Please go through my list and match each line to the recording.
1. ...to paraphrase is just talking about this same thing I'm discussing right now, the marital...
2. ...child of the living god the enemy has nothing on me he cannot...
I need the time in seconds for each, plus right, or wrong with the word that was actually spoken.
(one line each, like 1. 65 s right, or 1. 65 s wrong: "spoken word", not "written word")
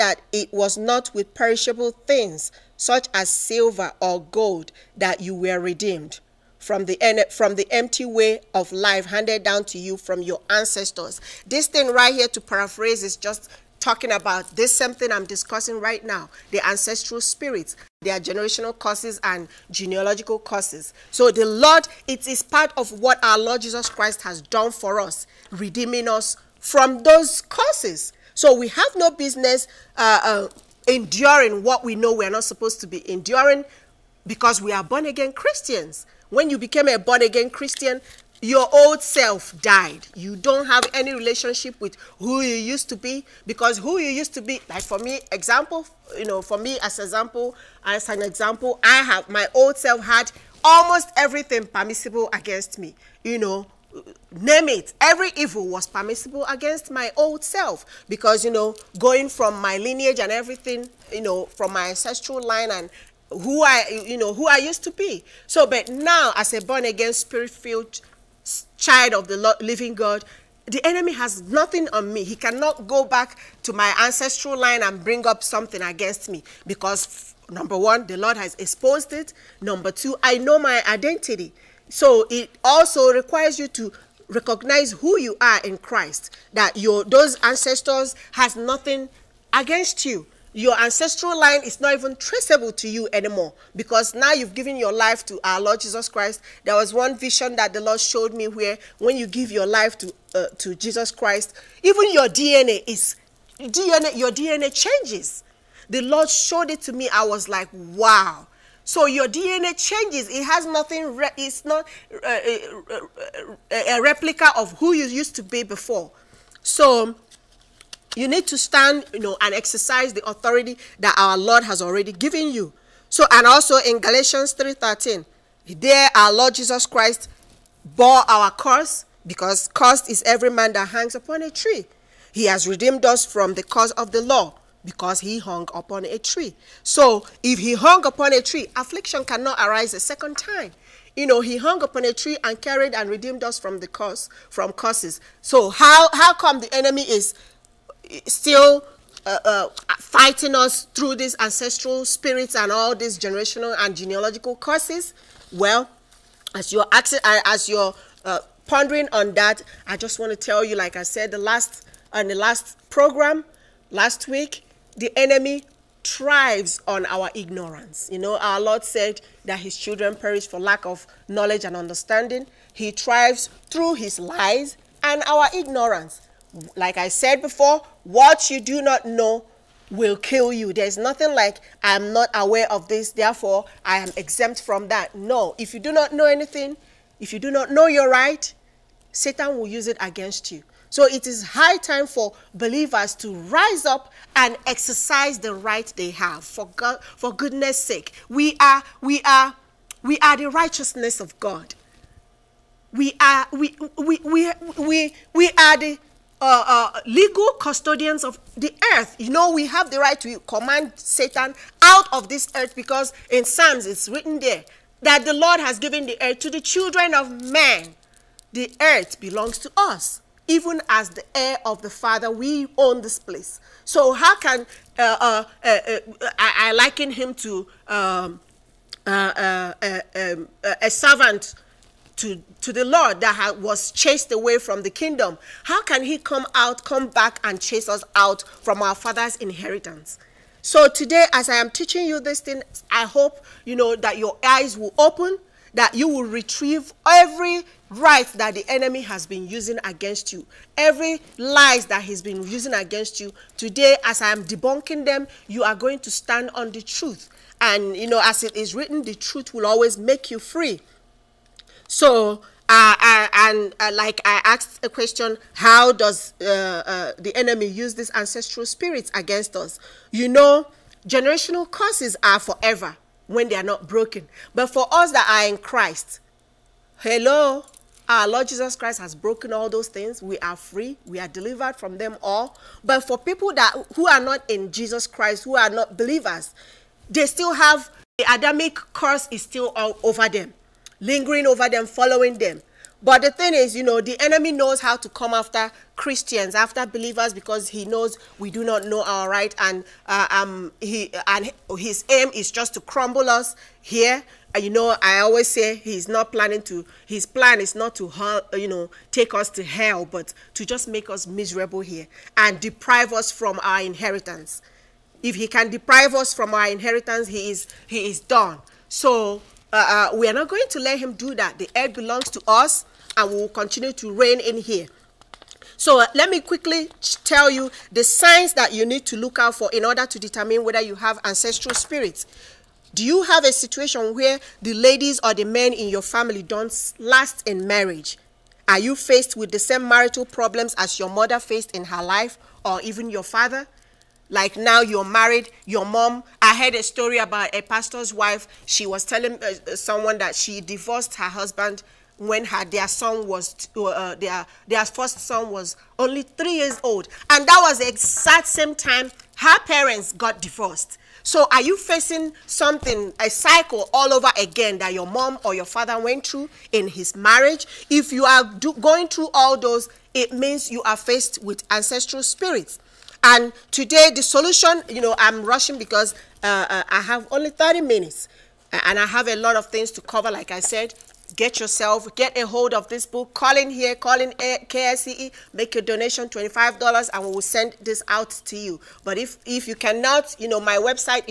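1. 12 s wrong: "ancestral", not "marital"
2. 68 s right.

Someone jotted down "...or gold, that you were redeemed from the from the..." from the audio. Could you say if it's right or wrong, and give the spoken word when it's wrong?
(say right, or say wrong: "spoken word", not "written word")
right.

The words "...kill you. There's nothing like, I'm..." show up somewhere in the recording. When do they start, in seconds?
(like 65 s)
180 s.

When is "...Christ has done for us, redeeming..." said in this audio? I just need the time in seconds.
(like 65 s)
23 s.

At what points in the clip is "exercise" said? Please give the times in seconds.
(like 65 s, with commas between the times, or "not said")
119 s, 194 s.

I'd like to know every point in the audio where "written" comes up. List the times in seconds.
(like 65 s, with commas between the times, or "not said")
214 s, 258 s.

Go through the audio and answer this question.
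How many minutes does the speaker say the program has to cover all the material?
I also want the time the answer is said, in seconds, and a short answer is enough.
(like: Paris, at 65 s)
30, at 377 s.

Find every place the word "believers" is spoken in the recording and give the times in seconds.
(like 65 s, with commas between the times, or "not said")
192 s, 285 s, 296 s.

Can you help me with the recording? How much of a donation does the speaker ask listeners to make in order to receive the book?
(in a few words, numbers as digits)
$25.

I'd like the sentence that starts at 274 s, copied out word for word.
But for us that are in Christ, hello, our Lord Jesus Christ has broken all those things.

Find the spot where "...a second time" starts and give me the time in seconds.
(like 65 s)
139 s.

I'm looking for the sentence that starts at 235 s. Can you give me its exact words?
How can he come out, come back, and chase us out from our Father's inheritance?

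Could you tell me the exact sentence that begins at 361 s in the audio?
So are you facing something, a cycle all over again that your mom or your father went through in his marriage?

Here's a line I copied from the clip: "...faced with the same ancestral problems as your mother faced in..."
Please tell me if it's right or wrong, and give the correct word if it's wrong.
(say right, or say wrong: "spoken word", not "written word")
wrong: "marital", not "ancestral".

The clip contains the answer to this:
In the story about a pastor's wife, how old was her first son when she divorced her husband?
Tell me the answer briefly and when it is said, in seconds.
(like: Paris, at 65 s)
3, at 356 s.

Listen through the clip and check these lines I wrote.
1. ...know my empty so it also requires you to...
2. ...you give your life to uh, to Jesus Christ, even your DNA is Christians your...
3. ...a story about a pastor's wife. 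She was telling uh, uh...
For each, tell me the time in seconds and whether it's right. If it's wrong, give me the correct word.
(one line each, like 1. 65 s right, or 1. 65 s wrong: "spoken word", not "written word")
1. 80 s wrong: "identity", not "empty"
2. 99 s wrong: "DNA", not "Christians"
3. 346 s right.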